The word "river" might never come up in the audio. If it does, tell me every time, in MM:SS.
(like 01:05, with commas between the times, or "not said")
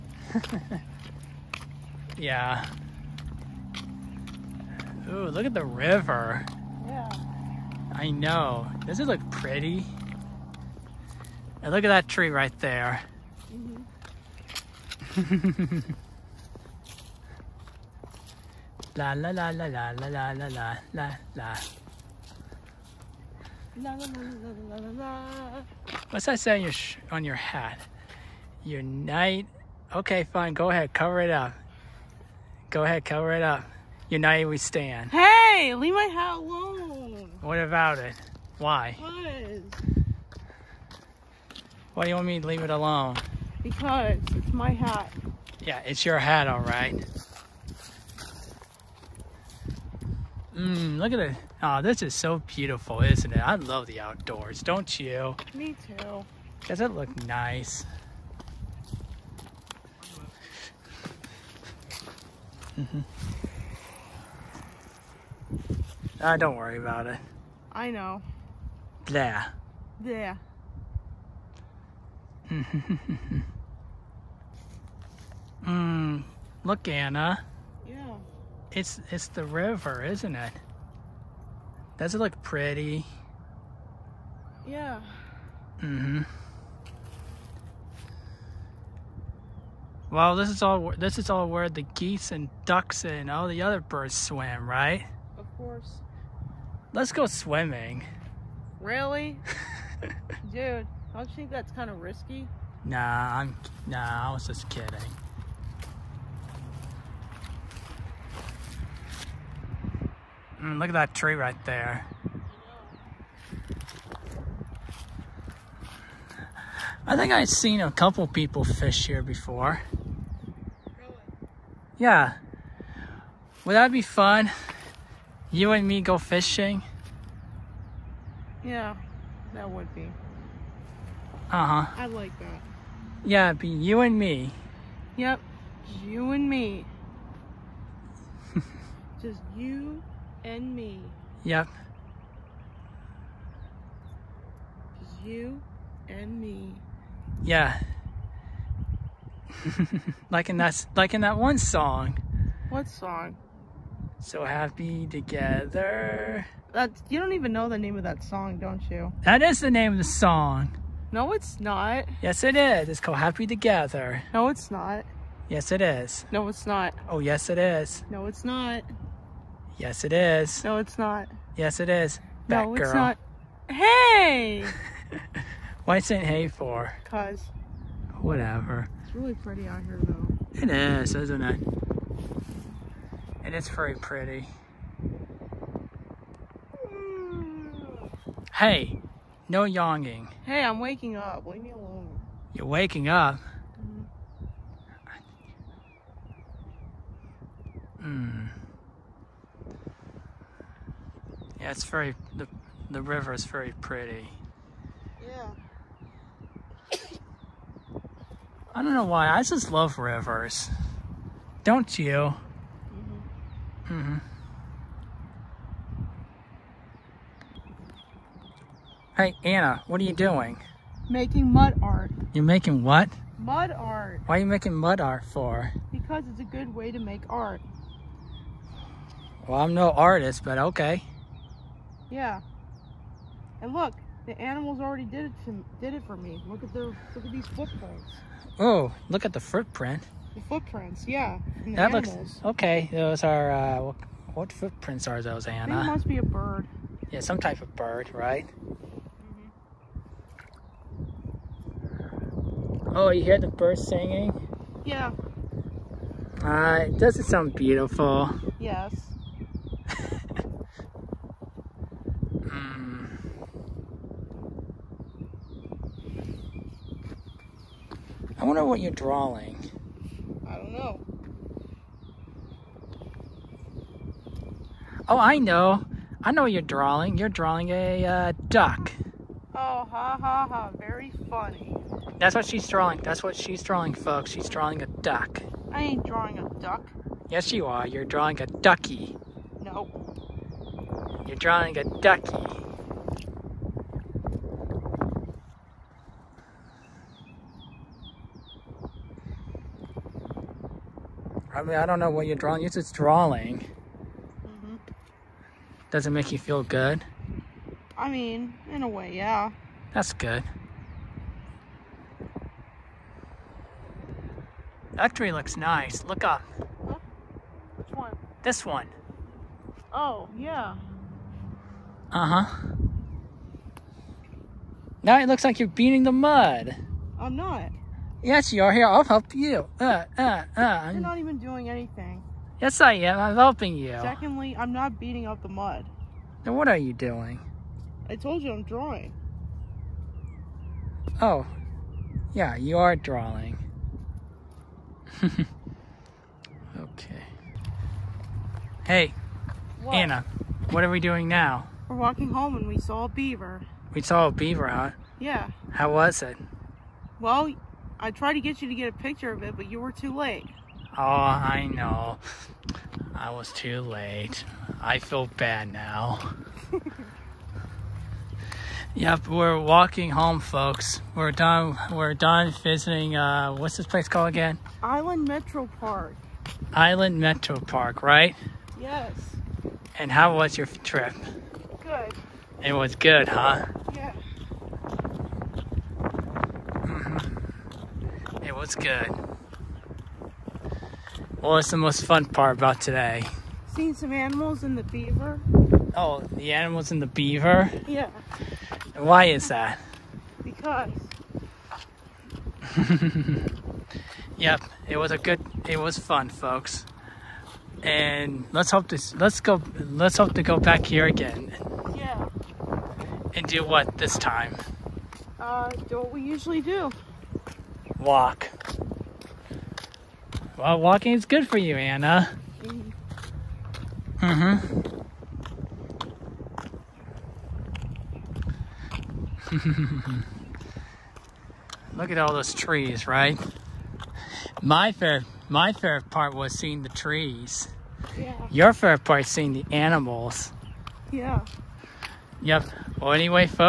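00:05, 01:19, 03:23, 03:29.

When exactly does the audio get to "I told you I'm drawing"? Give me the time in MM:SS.
05:38.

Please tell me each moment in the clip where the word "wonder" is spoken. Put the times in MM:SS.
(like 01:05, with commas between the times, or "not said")
04:28.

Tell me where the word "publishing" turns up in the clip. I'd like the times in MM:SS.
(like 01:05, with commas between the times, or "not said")
not said.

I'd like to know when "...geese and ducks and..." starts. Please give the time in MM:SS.
01:31.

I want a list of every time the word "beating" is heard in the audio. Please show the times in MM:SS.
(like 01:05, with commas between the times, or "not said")
05:25, 05:34.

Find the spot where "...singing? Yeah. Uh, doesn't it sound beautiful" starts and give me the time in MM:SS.
04:13.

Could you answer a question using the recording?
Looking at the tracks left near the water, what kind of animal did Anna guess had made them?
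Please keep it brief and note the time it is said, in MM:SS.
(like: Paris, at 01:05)
A bird, at 04:05.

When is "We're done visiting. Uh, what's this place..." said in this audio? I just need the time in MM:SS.
06:11.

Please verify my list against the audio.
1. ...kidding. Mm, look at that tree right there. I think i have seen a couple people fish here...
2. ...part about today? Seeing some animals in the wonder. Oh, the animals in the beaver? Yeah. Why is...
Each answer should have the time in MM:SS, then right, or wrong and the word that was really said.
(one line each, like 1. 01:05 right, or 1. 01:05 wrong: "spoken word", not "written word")
1. 01:44 right
2. 06:32 wrong: "beaver", not "wonder".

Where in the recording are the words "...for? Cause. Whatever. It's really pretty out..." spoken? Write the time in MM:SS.
02:56.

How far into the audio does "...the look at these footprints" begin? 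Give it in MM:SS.
03:56.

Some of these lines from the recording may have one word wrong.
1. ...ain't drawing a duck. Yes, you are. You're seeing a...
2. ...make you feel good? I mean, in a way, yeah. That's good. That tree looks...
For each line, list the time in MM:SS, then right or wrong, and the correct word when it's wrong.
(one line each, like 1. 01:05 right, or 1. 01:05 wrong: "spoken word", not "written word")
1. 04:45 wrong: "drawing", not "seeing"
2. 05:06 right.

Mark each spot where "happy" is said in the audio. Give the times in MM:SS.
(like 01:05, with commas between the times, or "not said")
02:34, 02:43.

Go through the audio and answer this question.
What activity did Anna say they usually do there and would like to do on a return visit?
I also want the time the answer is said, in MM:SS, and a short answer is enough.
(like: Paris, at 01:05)
Walk, at 06:58.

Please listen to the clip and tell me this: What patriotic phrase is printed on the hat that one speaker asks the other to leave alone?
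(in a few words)
United we stand.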